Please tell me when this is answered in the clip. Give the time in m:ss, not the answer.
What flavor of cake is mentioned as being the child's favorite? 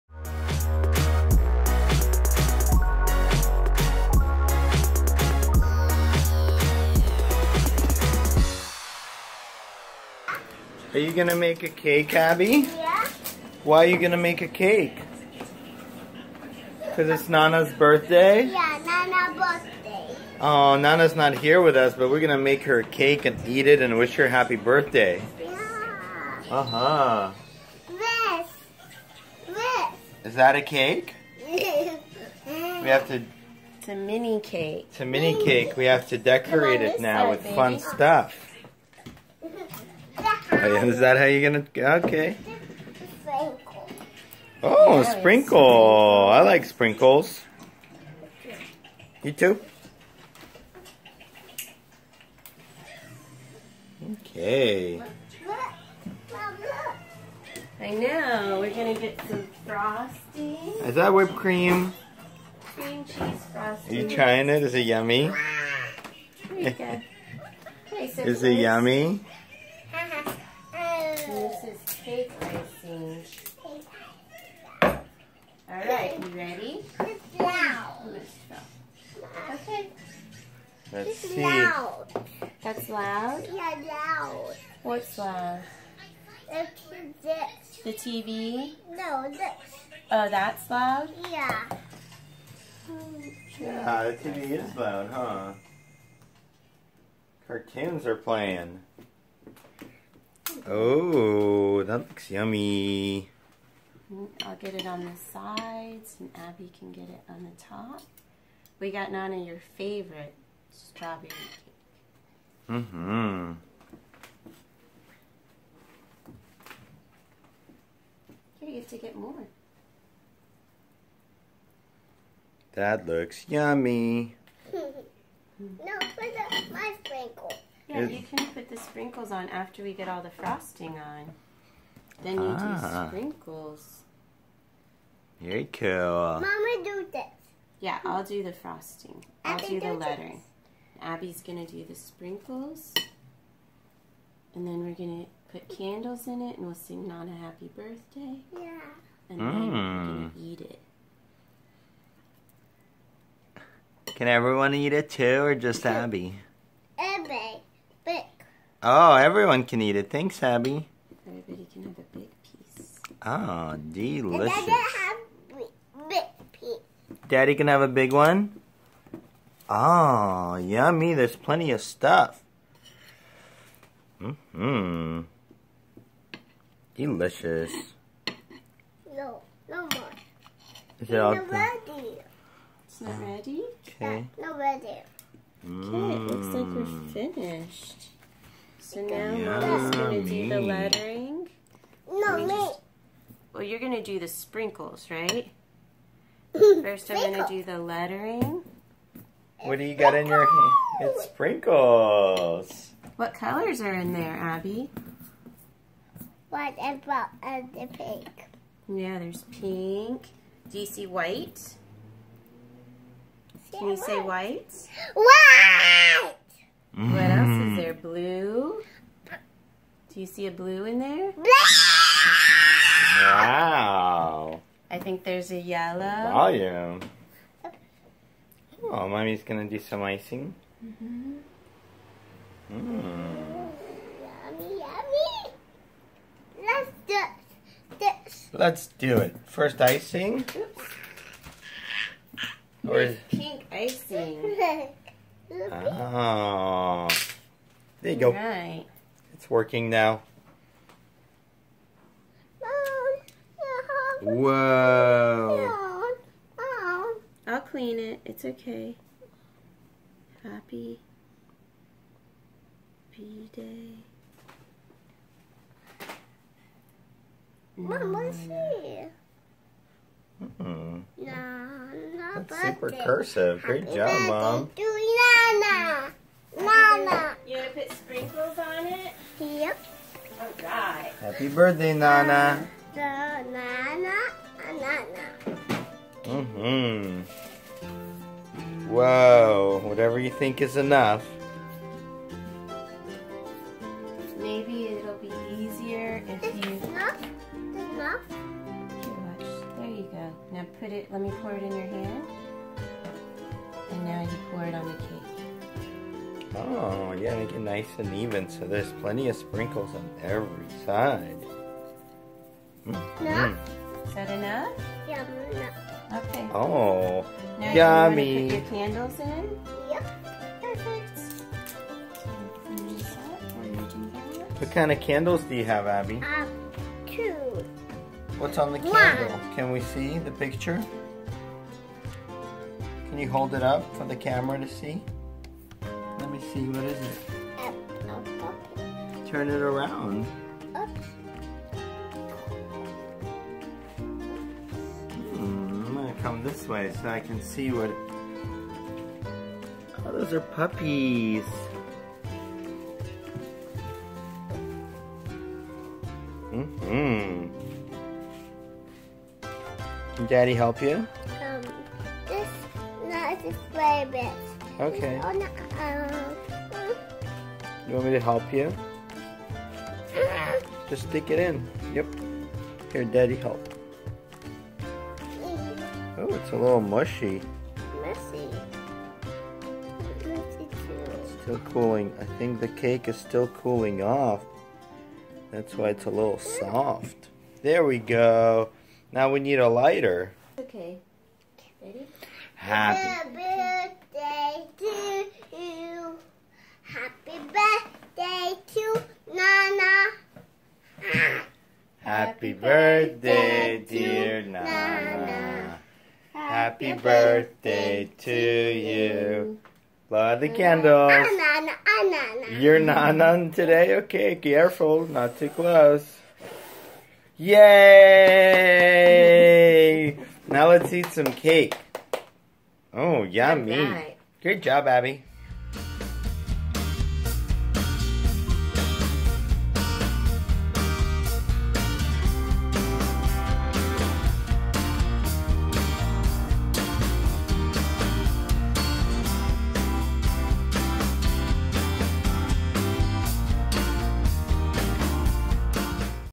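1:50.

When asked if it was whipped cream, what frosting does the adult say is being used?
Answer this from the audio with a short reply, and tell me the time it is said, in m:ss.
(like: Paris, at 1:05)
Cream cheese frosting, at 1:02.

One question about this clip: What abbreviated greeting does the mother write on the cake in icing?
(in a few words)
Happy B Day.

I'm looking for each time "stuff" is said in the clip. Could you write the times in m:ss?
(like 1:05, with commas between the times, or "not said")
0:37, 2:51.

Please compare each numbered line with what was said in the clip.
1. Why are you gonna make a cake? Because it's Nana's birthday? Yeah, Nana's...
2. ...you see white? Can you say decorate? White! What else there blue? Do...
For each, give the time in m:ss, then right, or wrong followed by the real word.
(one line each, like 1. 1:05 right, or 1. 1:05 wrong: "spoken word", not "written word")
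1. 0:13 right
2. 3:30 wrong: "white", not "decorate".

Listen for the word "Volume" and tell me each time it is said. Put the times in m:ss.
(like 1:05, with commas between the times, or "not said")
3:46.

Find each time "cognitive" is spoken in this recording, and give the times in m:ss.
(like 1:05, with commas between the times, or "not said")
not said.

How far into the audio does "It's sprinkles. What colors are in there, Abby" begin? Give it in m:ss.
3:21.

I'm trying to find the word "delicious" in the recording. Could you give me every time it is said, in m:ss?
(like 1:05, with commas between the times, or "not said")
2:43, 2:56.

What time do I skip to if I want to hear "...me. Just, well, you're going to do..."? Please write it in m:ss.
3:12.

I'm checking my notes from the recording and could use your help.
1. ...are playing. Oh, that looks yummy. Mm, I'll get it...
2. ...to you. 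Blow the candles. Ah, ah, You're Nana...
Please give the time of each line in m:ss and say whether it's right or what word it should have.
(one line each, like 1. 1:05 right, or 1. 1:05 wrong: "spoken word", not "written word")
1. 1:38 right
2. 6:48 right.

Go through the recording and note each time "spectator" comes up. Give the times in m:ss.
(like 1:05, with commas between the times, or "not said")
not said.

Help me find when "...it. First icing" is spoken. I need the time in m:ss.
3:59.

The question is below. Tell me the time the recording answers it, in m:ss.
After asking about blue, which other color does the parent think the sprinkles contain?
3:45.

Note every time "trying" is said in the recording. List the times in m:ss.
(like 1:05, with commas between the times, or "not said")
1:04.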